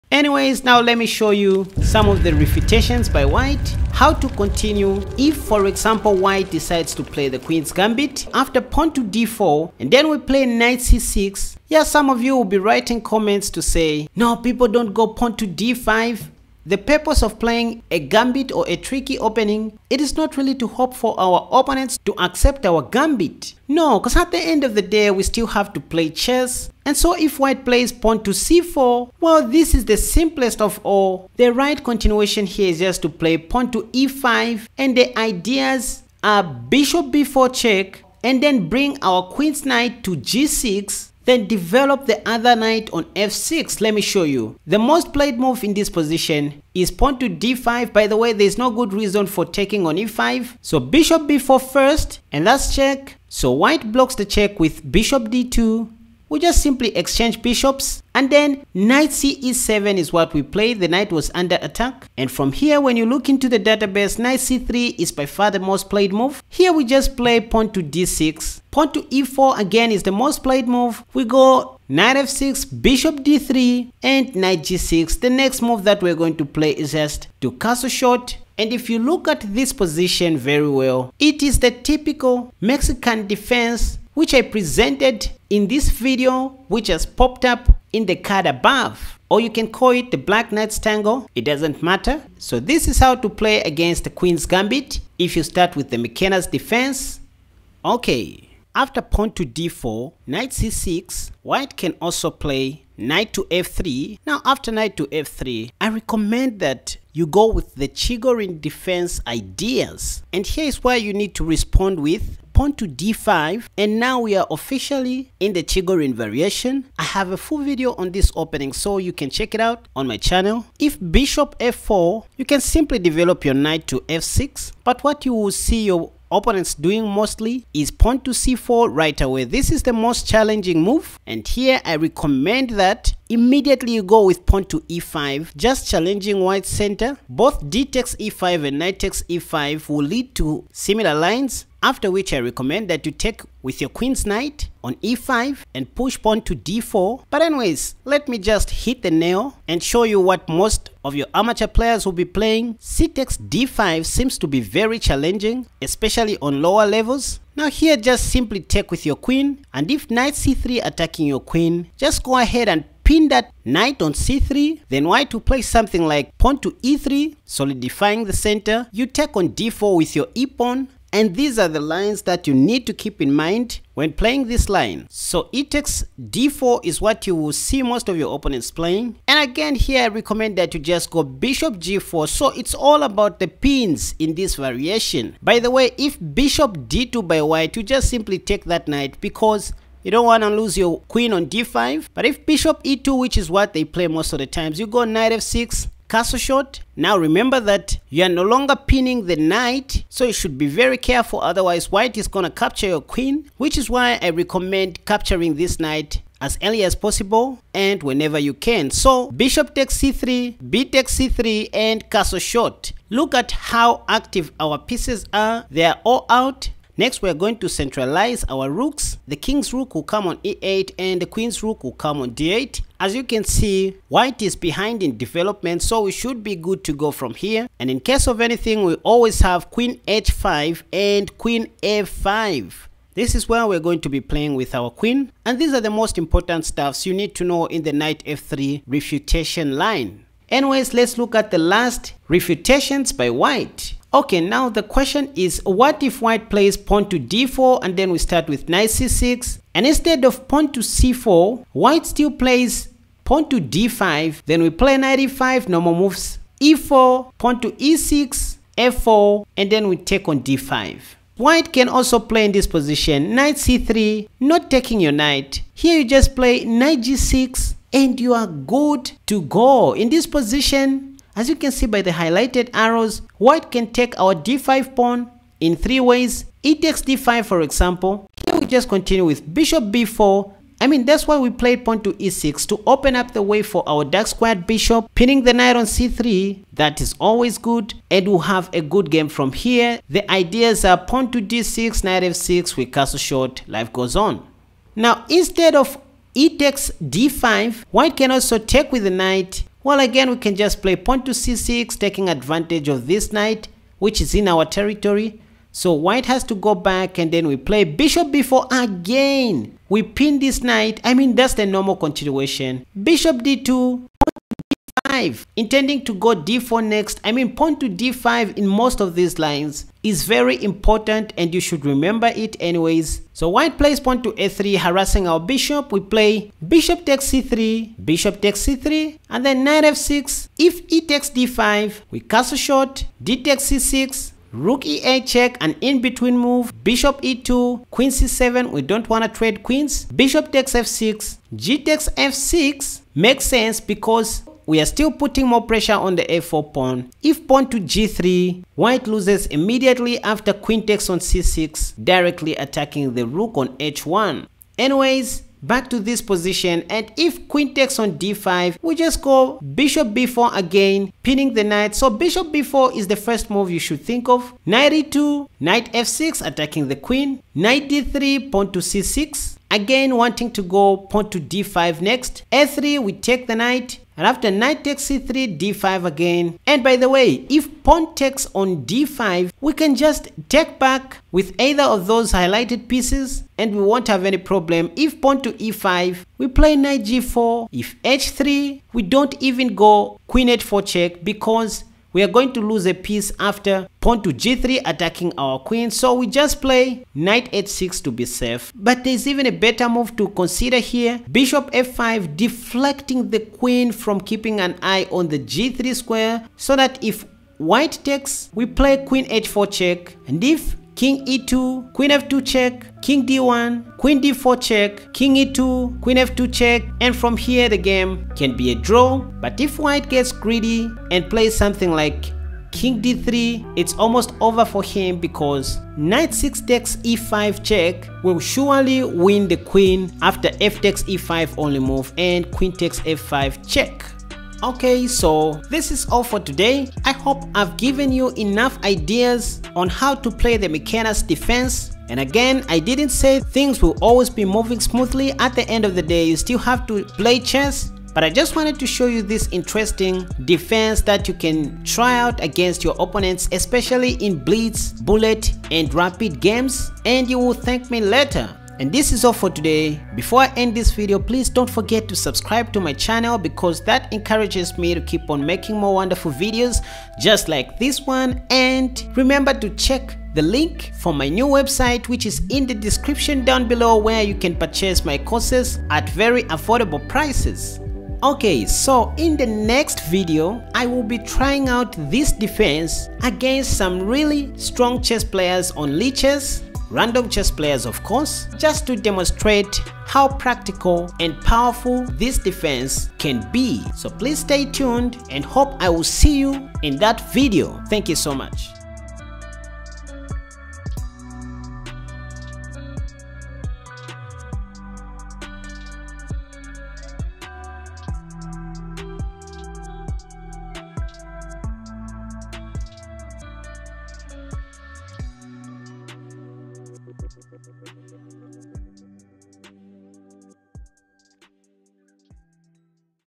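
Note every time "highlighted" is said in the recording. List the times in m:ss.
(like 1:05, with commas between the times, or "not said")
4:32, 6:22.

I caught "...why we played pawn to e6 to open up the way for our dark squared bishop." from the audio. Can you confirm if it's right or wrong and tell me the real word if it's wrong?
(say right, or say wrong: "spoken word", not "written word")
right.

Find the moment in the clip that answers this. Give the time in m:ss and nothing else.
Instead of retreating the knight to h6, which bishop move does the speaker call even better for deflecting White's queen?
6:41.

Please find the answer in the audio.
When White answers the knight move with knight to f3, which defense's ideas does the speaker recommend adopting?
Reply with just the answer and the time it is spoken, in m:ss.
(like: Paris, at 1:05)
Chigorin defense, at 1:47.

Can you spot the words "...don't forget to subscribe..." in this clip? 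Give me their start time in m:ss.
7:41.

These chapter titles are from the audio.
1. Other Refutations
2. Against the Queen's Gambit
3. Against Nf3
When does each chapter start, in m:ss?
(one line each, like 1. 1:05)
1. 4:04
2. 0:26
3. 1:38.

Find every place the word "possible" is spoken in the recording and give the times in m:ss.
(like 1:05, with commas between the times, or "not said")
3:26.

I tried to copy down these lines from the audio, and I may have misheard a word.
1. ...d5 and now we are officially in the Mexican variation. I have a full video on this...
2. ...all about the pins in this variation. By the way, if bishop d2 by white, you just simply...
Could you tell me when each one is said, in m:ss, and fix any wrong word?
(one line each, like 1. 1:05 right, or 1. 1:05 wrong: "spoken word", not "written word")
1. 1:52 wrong: "Chigorin", not "Mexican"
2. 3:02 right.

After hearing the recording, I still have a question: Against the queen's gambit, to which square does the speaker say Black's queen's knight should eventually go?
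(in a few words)
g6.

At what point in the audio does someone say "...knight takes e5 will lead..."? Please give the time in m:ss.
2:18.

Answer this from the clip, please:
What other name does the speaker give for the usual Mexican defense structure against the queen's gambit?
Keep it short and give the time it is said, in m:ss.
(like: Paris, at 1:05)
Black knight's tango, at 1:30.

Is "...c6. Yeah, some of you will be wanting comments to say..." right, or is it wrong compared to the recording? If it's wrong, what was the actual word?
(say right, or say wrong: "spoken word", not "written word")
wrong: "writing", not "wanting".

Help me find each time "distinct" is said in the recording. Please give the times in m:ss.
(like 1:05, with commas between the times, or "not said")
not said.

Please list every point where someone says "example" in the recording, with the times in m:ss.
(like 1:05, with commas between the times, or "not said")
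0:05, 4:37.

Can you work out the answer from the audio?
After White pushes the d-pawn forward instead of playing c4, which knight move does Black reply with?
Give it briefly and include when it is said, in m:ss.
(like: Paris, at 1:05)
knight e5, at 4:14.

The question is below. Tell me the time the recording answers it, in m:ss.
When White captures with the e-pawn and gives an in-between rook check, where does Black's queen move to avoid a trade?
5:37.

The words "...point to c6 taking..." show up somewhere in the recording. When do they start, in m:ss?
5:00.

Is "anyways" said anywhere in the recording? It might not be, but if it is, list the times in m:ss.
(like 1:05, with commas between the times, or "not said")
0:00, 2:27, 4:00, 5:22, 5:54.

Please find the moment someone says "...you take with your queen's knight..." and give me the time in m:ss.
2:23.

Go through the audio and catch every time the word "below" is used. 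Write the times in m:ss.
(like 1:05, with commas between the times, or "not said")
7:53.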